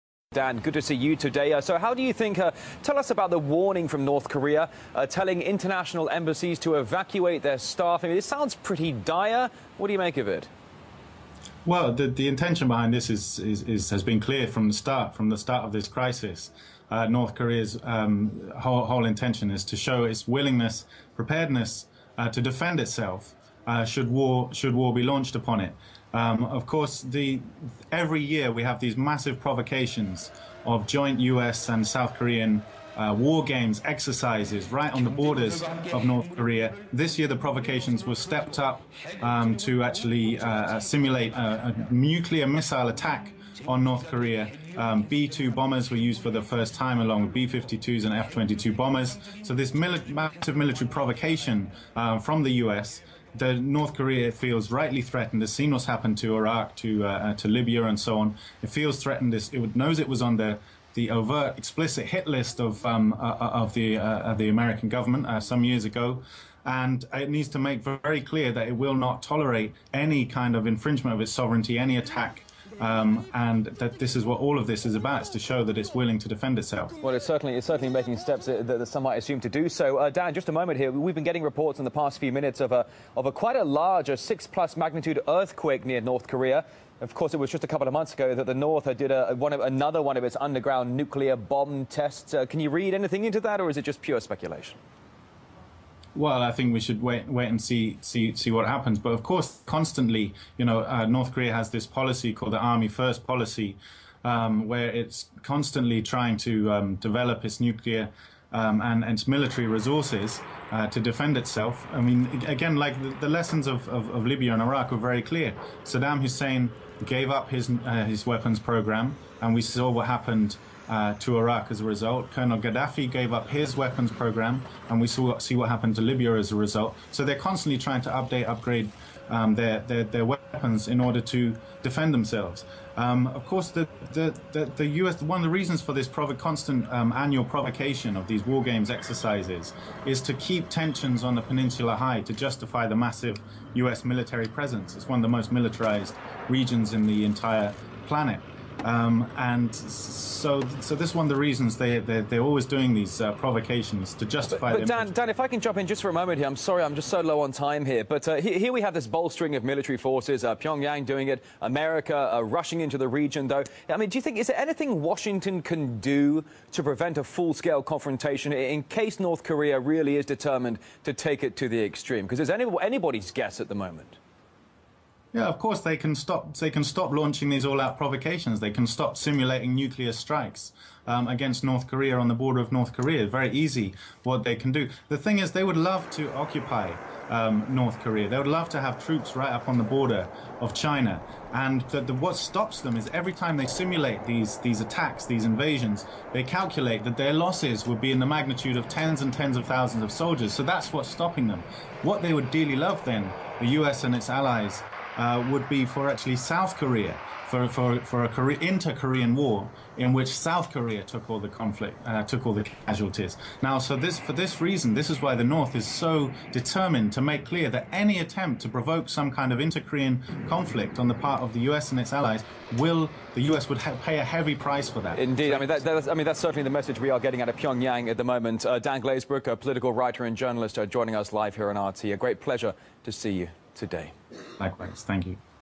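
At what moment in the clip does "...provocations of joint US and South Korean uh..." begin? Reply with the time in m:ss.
0:29.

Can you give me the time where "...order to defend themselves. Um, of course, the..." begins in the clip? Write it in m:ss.
2:11.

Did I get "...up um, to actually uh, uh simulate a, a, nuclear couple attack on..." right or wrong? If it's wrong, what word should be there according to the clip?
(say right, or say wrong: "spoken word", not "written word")
wrong: "missile", not "couple".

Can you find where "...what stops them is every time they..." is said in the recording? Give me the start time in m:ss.
3:12.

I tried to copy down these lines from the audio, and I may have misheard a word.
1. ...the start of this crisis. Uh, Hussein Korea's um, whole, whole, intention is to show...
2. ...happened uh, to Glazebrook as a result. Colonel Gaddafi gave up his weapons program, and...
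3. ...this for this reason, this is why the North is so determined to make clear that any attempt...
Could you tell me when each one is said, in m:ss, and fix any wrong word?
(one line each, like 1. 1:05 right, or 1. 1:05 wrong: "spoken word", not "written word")
1. 0:15 wrong: "North", not "Hussein"
2. 2:00 wrong: "Iraq", not "Glazebrook"
3. 3:33 right.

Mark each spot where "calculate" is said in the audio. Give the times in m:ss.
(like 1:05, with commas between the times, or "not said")
3:16.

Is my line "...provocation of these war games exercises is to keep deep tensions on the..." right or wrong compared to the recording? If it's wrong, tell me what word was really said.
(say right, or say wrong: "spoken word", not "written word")
right.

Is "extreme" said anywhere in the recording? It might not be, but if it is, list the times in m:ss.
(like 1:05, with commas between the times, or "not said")
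2:51.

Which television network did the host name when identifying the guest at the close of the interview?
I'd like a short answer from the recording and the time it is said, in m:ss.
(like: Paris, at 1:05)
RT, at 3:51.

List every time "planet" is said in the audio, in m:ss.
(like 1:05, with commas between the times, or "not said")
2:28.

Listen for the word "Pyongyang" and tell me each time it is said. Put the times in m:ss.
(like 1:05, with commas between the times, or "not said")
2:40, 3:47.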